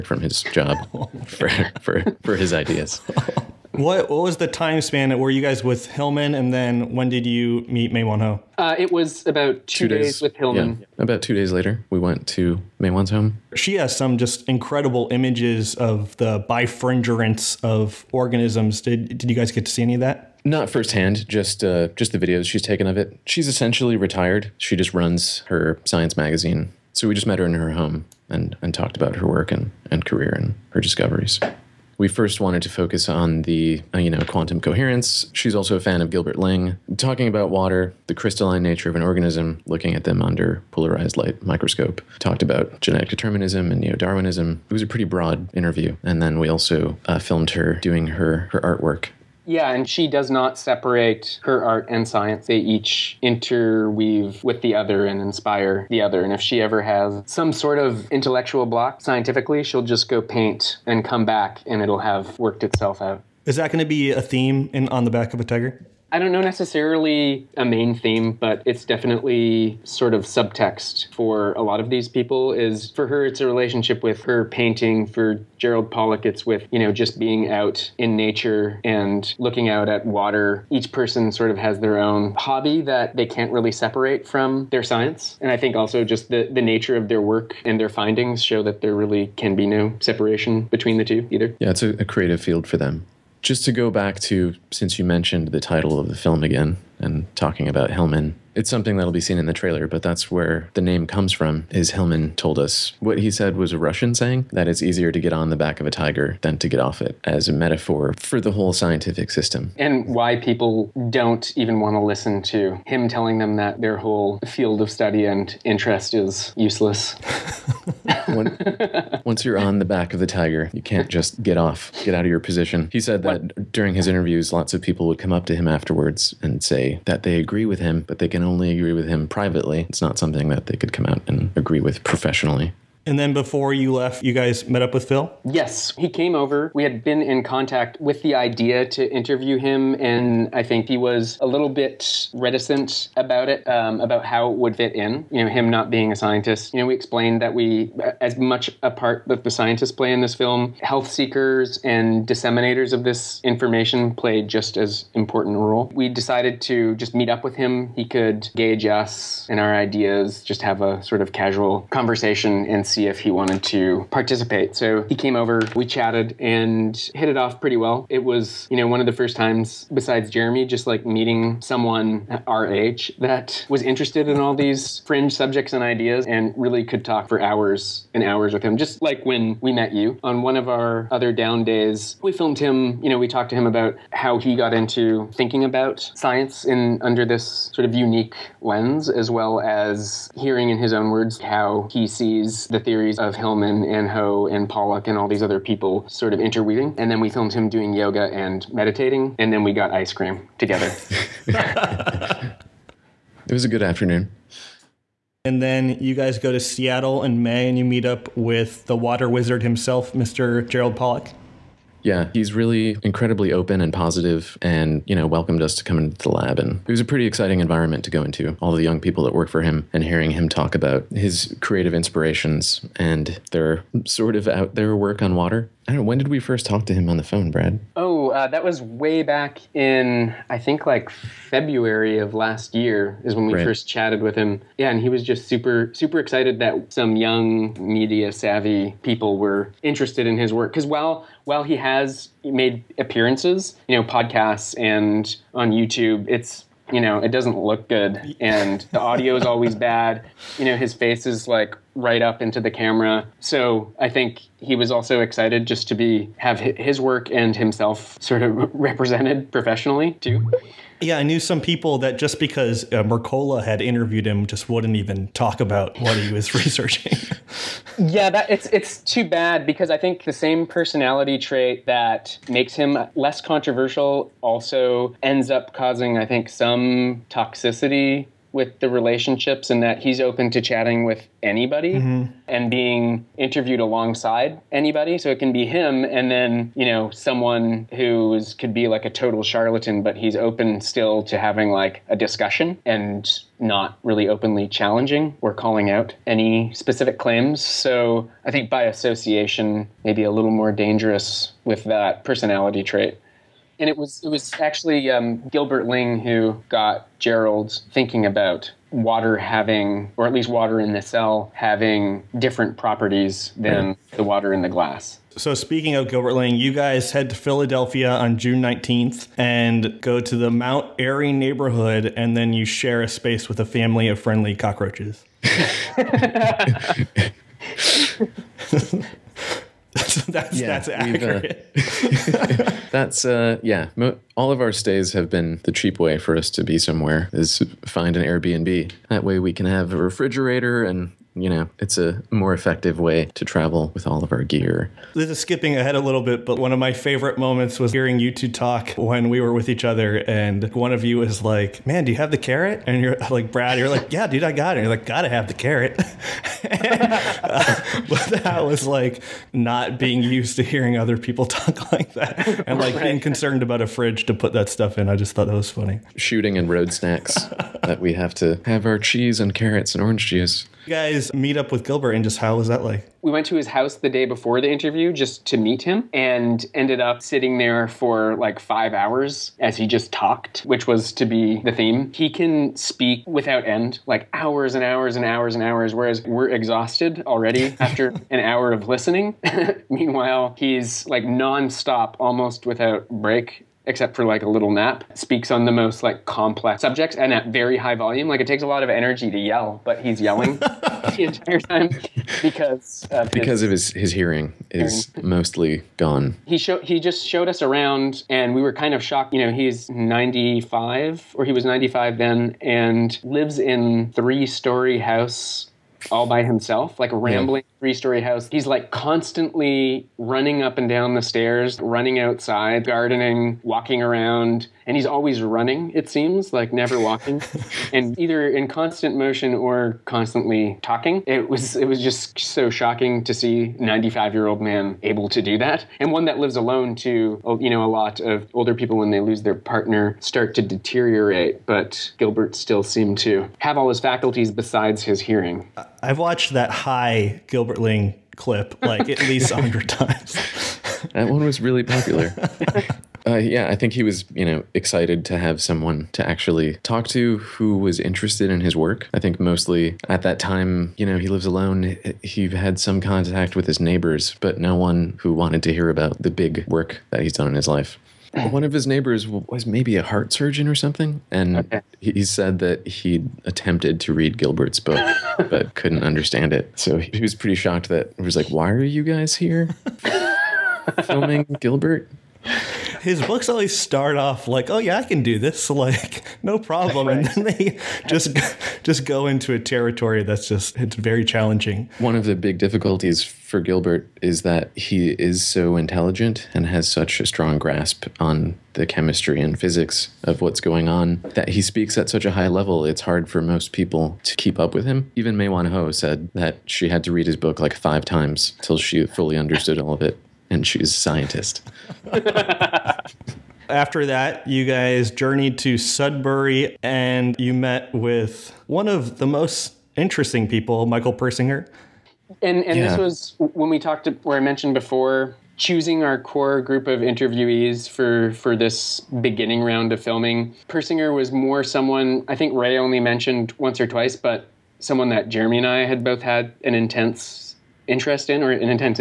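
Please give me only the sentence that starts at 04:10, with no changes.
You know, his face is like right up into the camera.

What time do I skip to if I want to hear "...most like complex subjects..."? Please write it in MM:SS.
06:35.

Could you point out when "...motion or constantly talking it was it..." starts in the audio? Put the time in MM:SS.
07:09.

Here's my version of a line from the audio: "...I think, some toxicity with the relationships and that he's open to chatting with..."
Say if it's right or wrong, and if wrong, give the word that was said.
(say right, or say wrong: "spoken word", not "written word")
right.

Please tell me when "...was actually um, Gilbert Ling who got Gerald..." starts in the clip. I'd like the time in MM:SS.
05:04.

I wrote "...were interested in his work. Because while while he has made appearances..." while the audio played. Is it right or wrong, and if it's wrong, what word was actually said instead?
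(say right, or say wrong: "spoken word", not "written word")
right.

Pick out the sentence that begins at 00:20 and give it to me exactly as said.
Not firsthand, just uh, just the videos she's taken of it.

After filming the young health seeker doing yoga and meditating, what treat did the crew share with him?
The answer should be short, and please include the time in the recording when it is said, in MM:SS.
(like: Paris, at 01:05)
Ice cream, at 03:19.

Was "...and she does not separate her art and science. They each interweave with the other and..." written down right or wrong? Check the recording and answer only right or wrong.
right.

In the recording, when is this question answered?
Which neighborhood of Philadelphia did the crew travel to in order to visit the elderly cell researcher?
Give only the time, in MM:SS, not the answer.
05:20.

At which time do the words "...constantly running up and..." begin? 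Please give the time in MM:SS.
06:58.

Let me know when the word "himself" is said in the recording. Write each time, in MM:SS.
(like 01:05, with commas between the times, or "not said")
03:29, 04:17, 06:56.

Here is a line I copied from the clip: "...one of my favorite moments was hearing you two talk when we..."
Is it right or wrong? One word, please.
right.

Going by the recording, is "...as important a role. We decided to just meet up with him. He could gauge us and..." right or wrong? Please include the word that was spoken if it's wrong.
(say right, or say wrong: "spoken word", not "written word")
right.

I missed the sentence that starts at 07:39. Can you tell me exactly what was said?
I think mostly at that time, you know, he lives alone.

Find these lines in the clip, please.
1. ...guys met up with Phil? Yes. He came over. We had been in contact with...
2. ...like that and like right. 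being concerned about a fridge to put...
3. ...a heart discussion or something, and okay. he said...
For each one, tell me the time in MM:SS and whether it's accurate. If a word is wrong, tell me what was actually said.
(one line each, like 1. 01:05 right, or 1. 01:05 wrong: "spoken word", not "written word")
1. 02:14 right
2. 06:01 right
3. 07:49 wrong: "surgeon", not "discussion".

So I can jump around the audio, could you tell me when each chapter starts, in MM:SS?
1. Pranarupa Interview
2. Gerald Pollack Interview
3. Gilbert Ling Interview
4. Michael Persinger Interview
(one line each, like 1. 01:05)
1. 02:12
2. 03:22
3. 05:12
4. 08:32.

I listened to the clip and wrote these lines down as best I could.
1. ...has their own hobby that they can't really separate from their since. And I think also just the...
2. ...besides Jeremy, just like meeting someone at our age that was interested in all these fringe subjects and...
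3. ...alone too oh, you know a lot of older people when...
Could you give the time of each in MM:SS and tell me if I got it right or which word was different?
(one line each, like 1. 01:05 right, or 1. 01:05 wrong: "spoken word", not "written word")
1. 01:21 wrong: "science", not "since"
2. 02:49 right
3. 07:16 right.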